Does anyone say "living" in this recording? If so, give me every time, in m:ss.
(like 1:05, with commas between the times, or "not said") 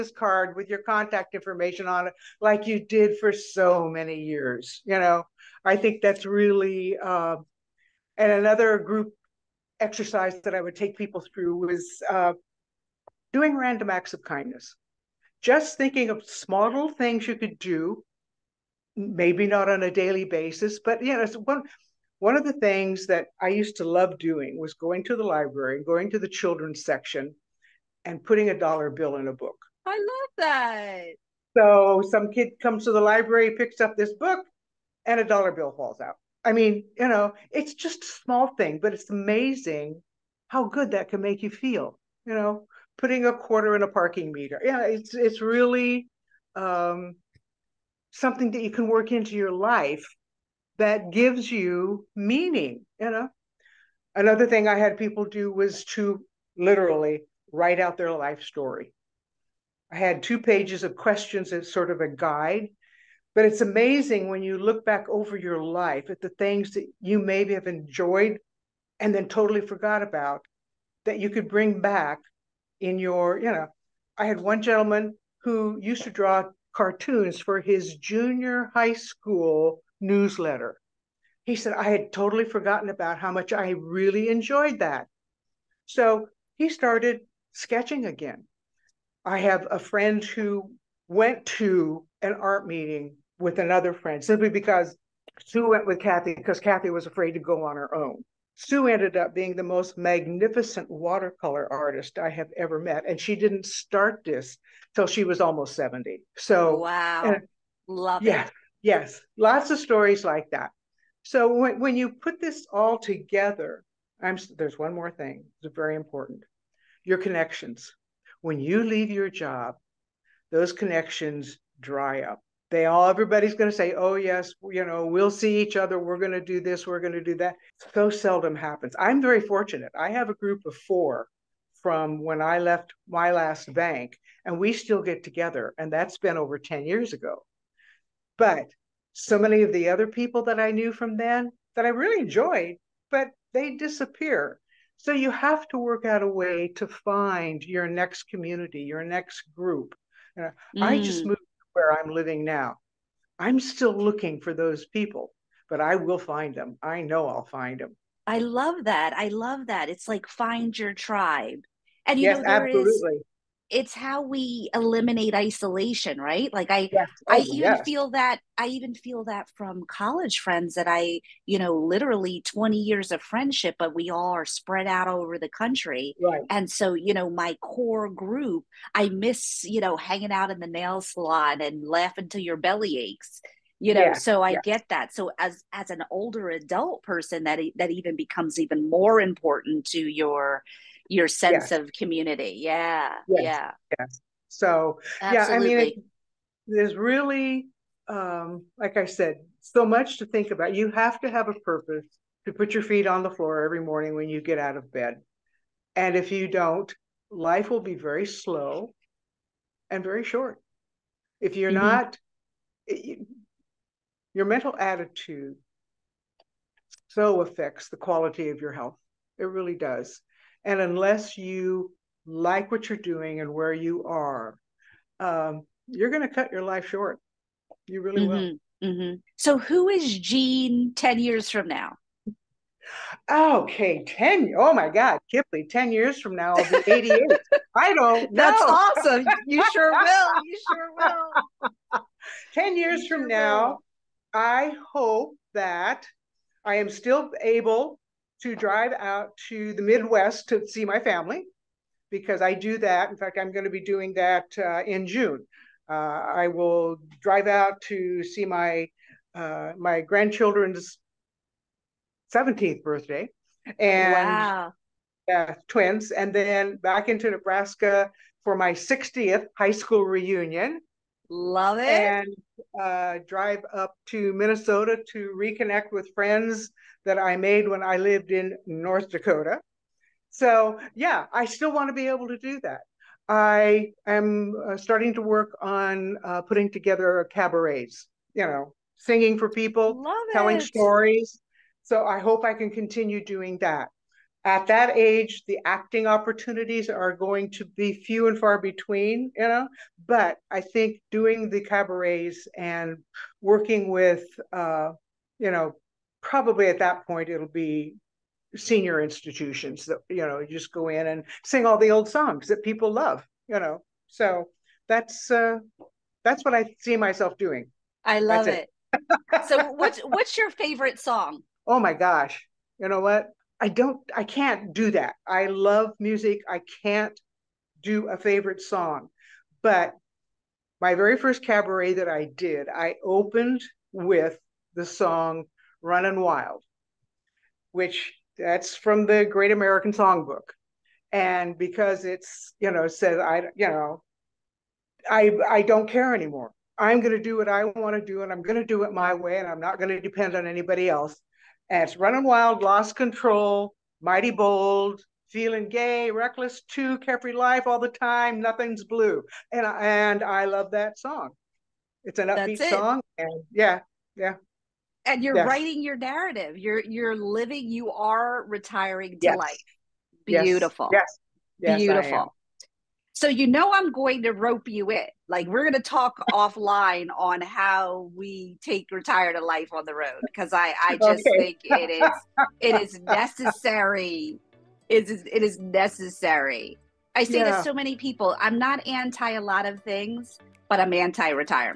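2:32, 6:07.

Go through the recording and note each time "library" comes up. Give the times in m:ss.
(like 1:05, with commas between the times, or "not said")
0:25, 0:32.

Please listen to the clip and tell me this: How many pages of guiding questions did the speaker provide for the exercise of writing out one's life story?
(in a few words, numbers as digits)
2.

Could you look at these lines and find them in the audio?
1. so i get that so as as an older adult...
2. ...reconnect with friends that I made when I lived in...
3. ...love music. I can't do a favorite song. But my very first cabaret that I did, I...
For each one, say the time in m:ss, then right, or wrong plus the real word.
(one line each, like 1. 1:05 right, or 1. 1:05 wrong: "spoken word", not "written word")
1. 3:04 right
2. 4:35 right
3. 5:25 right.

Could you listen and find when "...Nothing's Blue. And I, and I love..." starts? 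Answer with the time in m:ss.
5:58.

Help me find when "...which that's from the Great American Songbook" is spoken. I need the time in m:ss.
5:37.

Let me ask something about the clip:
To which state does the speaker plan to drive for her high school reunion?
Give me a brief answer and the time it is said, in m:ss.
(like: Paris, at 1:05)
Nebraska, at 4:27.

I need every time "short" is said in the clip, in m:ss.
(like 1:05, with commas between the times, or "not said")
3:30, 3:46.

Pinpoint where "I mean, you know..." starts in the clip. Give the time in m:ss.
0:36.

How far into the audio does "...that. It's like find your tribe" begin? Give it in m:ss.
2:39.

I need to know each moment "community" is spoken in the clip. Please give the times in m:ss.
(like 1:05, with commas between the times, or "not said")
2:28, 3:11.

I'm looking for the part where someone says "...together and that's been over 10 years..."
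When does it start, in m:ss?
2:15.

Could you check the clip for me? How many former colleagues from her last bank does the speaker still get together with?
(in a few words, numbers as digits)
4.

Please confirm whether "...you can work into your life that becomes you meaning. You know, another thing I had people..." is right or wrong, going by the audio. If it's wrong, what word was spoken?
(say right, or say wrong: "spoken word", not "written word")
wrong: "gives", not "becomes".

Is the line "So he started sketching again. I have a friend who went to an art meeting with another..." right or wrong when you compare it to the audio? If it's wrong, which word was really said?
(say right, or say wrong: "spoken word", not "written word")
right.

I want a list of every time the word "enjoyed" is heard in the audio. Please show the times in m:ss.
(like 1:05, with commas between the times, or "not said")
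1:07, 1:24, 2:22.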